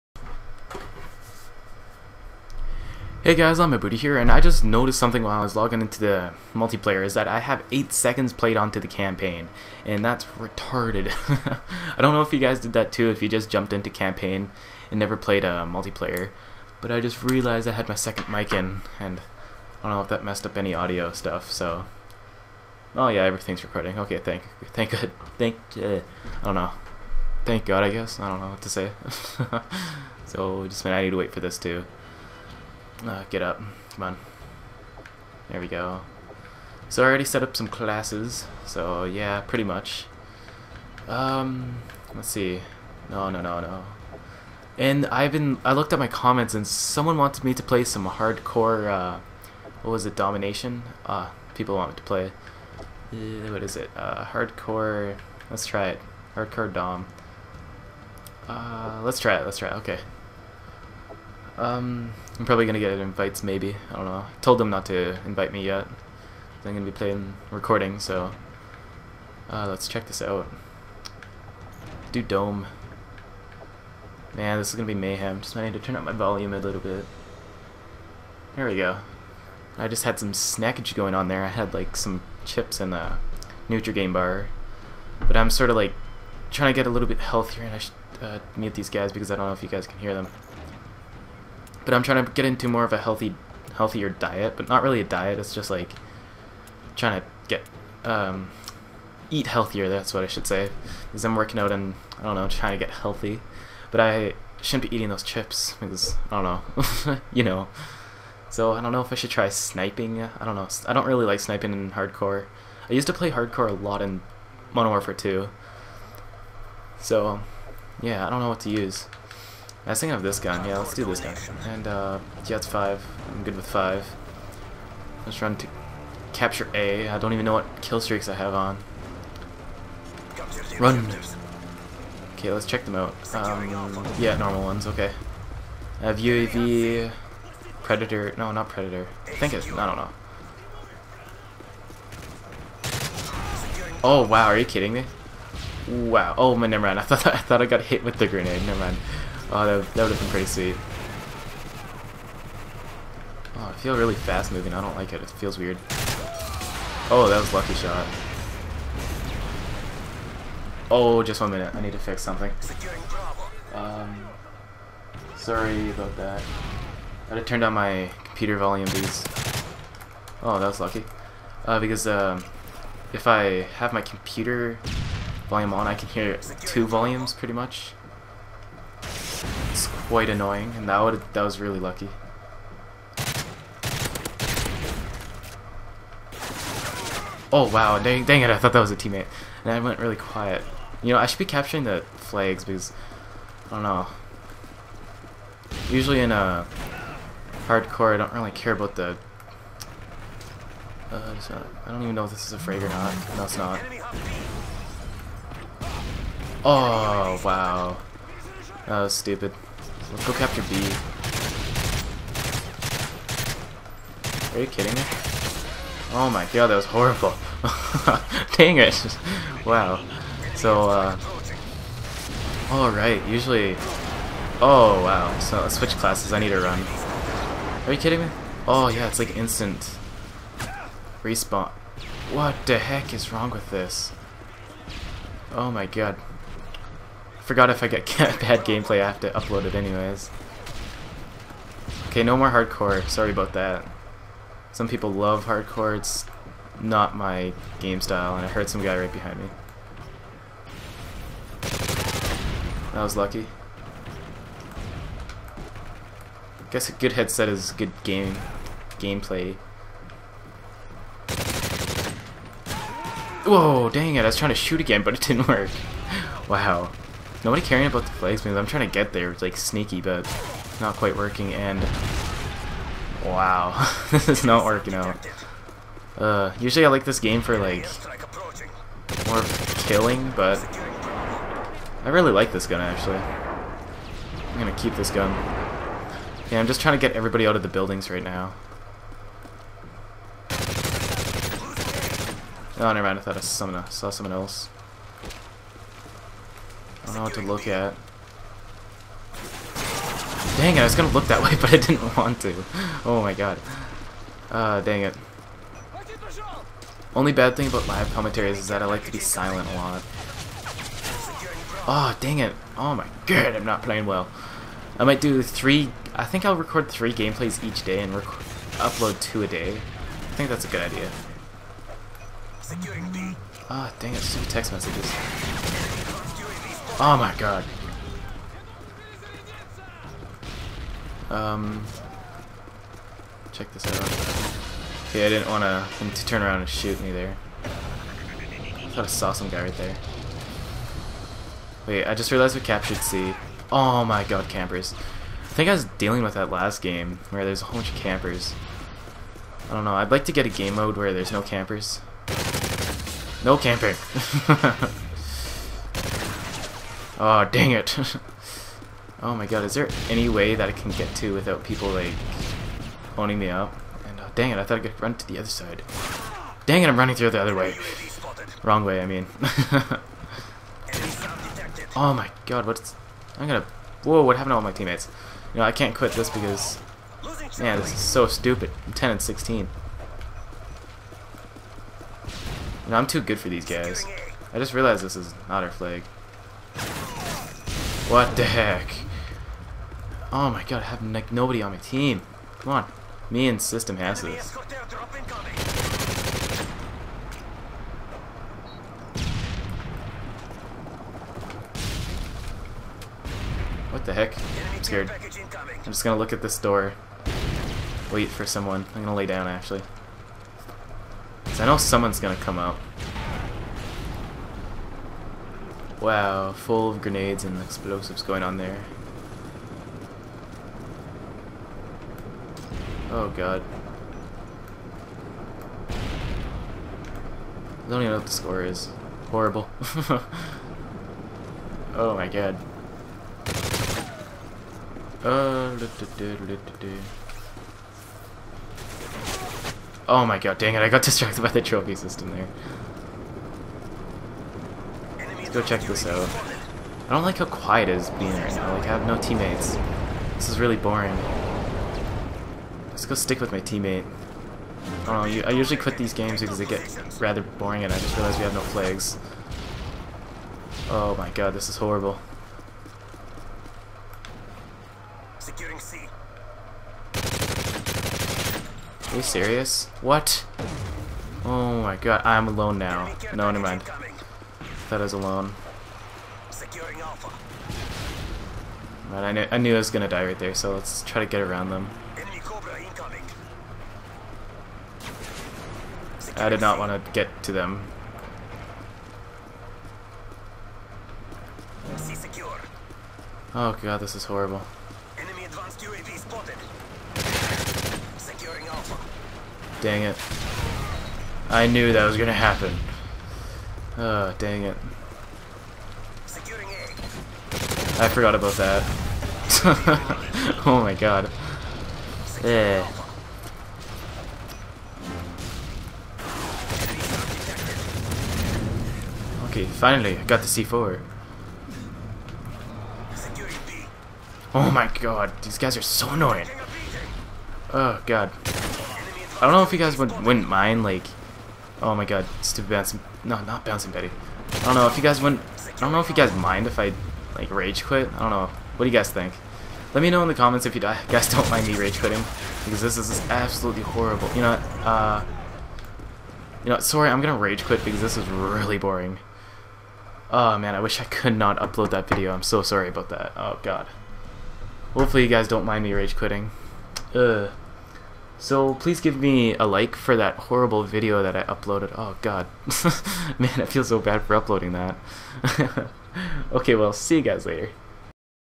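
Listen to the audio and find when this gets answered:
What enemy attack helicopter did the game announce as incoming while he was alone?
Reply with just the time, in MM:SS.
08:02.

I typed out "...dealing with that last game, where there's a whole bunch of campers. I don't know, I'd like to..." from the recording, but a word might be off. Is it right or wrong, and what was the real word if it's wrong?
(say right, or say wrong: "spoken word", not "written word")
right.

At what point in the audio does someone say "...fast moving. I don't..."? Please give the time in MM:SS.
02:34.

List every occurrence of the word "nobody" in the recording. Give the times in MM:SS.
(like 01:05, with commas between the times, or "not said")
04:27, 06:31.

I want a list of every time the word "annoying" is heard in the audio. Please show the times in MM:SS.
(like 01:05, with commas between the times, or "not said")
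03:00, 08:46.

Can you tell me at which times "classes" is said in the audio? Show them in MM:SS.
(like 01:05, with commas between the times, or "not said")
00:37, 03:45.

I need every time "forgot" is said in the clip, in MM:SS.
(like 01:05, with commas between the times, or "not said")
03:57, 08:28.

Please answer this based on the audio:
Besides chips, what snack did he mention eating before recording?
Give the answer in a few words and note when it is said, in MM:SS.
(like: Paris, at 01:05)
Nutri-Grain bar, at 01:23.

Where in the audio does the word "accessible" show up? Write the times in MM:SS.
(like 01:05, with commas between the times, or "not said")
not said.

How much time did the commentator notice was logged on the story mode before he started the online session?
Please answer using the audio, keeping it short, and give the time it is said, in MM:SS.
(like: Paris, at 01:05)
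8 seconds, at 00:07.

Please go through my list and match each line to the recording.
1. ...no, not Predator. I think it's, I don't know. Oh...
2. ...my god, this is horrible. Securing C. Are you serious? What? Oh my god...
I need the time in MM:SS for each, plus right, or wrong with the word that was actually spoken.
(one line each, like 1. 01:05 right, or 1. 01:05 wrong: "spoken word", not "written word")
1. 02:18 right
2. 07:41 right.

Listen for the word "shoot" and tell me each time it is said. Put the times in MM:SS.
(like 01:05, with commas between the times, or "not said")
04:24, 05:36.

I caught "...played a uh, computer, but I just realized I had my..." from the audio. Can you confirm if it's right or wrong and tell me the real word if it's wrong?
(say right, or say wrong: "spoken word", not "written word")
wrong: "multiplayer", not "computer".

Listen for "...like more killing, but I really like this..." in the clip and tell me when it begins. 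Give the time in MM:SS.
04:37.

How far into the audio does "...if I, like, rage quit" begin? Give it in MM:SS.
08:56.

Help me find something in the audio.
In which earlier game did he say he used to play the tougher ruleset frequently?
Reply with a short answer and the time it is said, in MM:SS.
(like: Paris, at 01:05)
Modern Warfare 2, at 01:54.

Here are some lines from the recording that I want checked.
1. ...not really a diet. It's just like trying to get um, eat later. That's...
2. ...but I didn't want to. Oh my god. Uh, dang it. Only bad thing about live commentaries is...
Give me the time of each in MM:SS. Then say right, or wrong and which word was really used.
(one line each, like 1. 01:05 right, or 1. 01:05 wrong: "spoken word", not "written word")
1. 01:34 wrong: "healthier", not "later"
2. 05:01 right.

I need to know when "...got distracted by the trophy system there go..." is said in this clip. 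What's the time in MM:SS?
07:20.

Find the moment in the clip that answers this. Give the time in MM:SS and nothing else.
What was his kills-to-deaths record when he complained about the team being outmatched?
06:18.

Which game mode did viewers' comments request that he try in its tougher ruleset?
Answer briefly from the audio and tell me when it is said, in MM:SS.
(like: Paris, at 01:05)
Domination, at 00:50.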